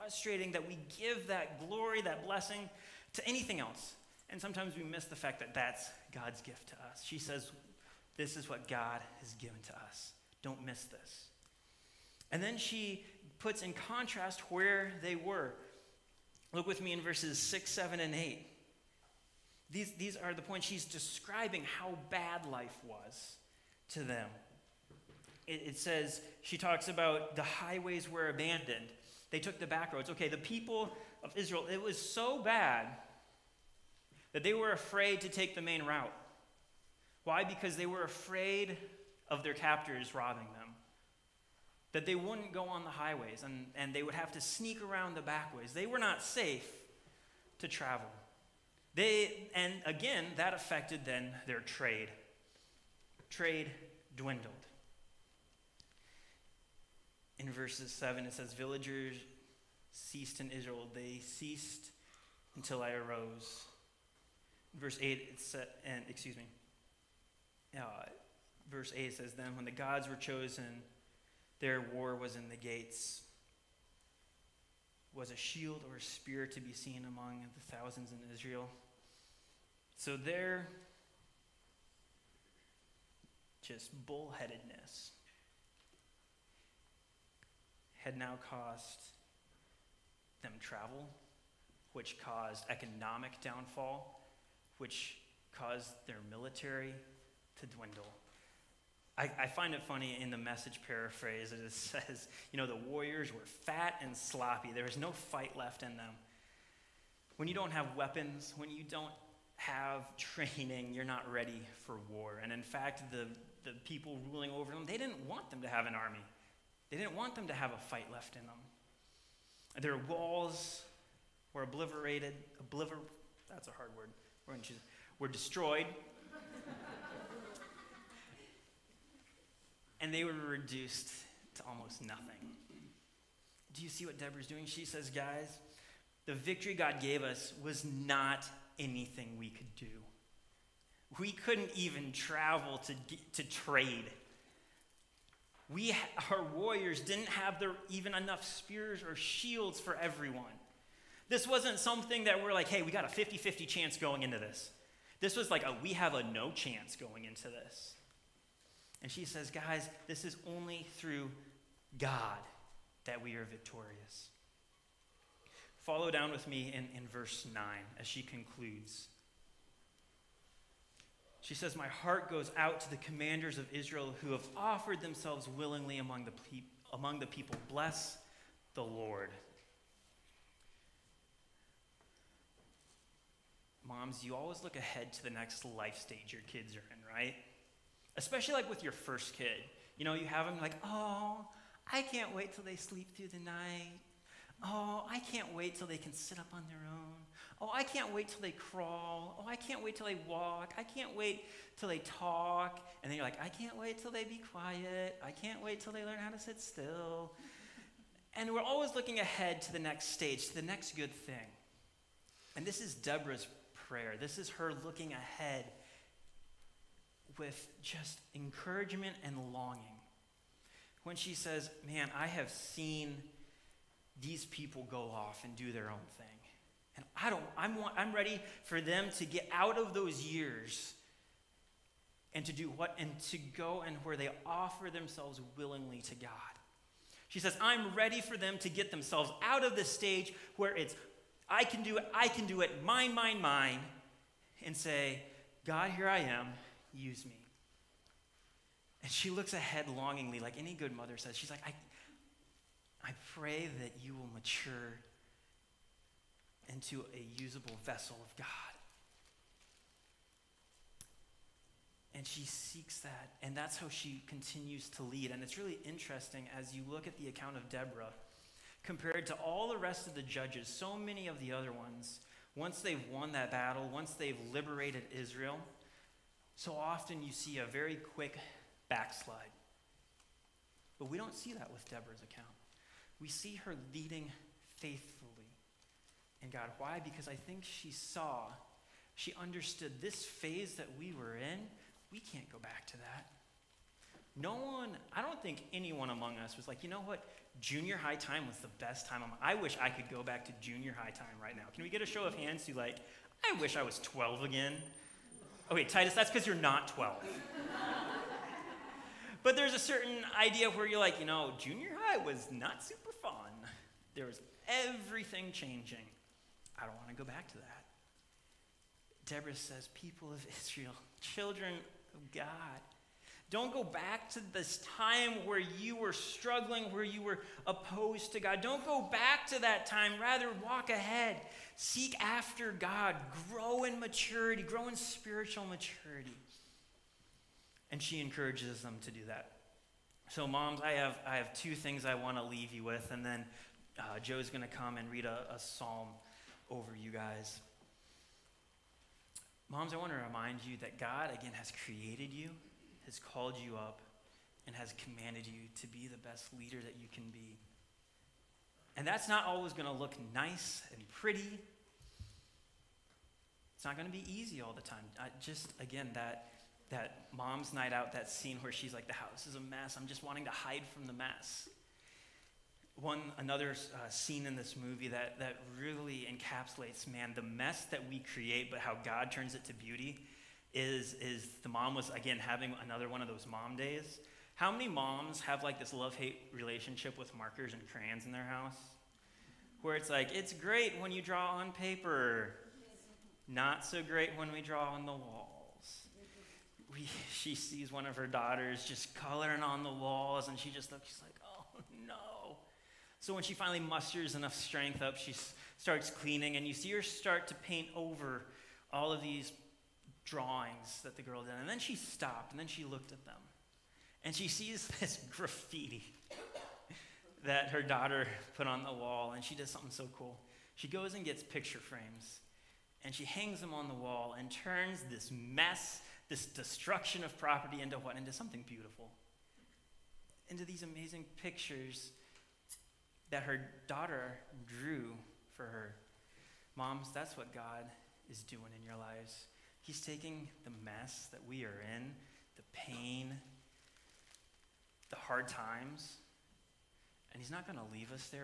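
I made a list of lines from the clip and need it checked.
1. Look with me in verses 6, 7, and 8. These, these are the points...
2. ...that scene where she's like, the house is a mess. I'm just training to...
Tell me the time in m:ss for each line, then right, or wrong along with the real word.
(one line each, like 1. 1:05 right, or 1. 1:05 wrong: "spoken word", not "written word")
1. 0:16 right
2. 6:08 wrong: "wanting", not "training".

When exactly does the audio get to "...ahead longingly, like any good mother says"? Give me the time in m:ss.
4:09.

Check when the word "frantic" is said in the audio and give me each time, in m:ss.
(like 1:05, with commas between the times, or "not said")
not said.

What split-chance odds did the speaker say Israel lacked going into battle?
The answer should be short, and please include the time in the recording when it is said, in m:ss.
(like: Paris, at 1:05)
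50 50, at 2:33.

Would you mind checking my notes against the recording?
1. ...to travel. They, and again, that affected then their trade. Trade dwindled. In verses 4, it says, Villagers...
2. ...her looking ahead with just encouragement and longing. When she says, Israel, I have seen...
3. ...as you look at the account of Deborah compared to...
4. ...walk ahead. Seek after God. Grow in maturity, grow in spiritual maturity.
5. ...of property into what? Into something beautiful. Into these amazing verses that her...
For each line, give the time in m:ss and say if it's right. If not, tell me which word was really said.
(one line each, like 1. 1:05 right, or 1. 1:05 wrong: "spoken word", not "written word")
1. 0:47 wrong: "7", not "4"
2. 3:34 wrong: "Man", not "Israel"
3. 4:26 right
4. 5:30 right
5. 7:07 wrong: "pictures", not "verses".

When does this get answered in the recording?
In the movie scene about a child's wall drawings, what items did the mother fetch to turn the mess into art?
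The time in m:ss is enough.
7:01.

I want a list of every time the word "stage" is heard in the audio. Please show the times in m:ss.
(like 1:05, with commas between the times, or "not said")
3:05, 3:30, 3:59.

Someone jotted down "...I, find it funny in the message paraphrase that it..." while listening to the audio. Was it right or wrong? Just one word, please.
right.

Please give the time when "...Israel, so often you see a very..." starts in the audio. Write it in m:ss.
4:35.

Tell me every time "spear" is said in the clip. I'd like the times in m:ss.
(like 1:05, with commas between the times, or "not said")
1:15, 2:28.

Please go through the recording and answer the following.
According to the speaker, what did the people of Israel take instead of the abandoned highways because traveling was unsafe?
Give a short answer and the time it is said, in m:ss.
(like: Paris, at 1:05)
The back roads, at 0:29.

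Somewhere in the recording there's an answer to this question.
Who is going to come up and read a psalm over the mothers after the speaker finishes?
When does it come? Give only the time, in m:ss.
5:44.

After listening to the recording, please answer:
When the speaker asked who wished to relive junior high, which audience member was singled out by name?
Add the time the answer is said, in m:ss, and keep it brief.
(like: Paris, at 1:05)
Titus, at 5:05.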